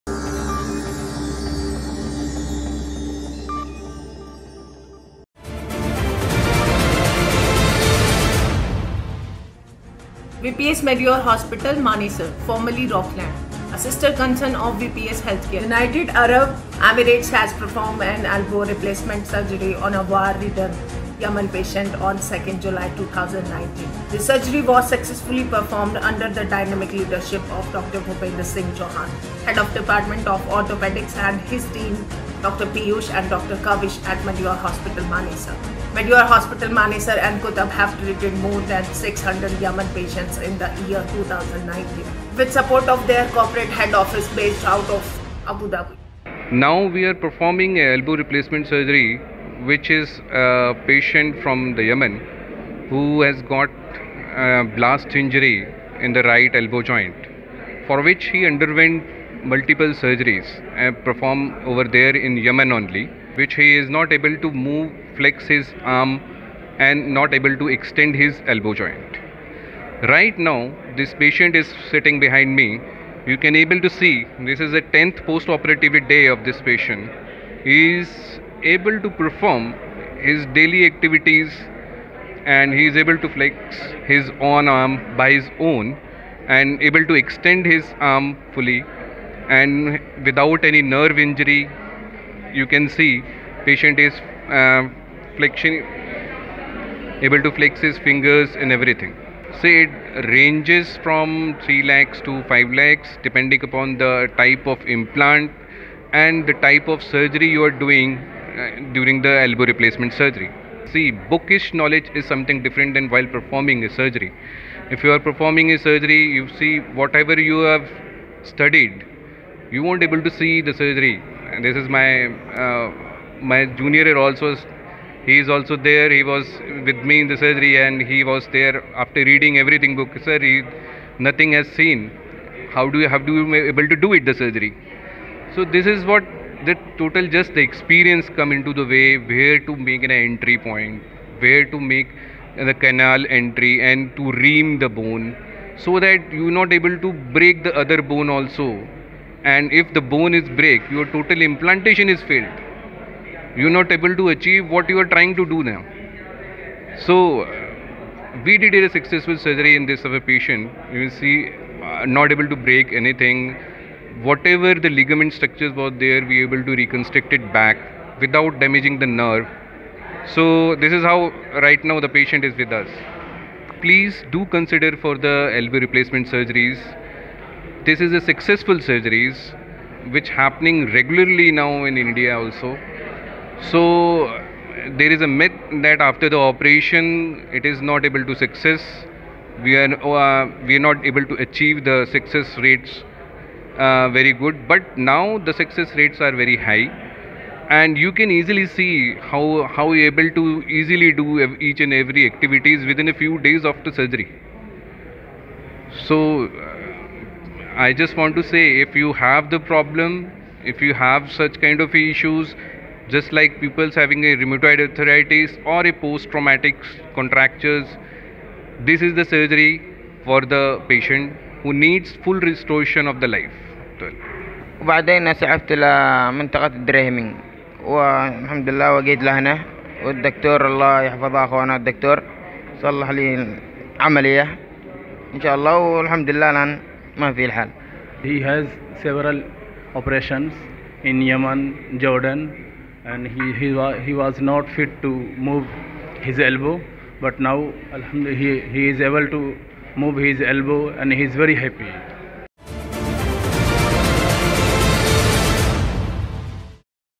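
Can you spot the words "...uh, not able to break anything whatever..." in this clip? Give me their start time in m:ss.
2:41.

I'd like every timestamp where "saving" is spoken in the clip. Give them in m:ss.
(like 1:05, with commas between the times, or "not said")
not said.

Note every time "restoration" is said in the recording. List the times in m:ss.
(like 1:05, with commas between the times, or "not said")
3:42.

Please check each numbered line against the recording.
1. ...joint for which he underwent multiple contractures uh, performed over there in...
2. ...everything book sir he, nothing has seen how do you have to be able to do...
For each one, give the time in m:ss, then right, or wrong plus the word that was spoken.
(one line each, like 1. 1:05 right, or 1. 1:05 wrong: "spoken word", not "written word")
1. 0:56 wrong: "surgeries", not "contractures"
2. 2:09 right.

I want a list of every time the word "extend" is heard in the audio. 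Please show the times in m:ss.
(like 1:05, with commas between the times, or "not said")
1:07, 1:27.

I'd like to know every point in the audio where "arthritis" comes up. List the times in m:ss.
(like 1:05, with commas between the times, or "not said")
3:34.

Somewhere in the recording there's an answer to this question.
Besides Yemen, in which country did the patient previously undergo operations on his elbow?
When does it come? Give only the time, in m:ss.
4:02.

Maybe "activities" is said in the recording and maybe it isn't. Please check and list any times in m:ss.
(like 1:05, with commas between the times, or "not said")
1:20, 3:22.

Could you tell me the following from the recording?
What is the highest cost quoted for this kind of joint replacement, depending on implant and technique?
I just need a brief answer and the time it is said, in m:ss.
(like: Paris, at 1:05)
5 lakhs, at 1:42.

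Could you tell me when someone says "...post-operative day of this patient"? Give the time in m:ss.
1:15.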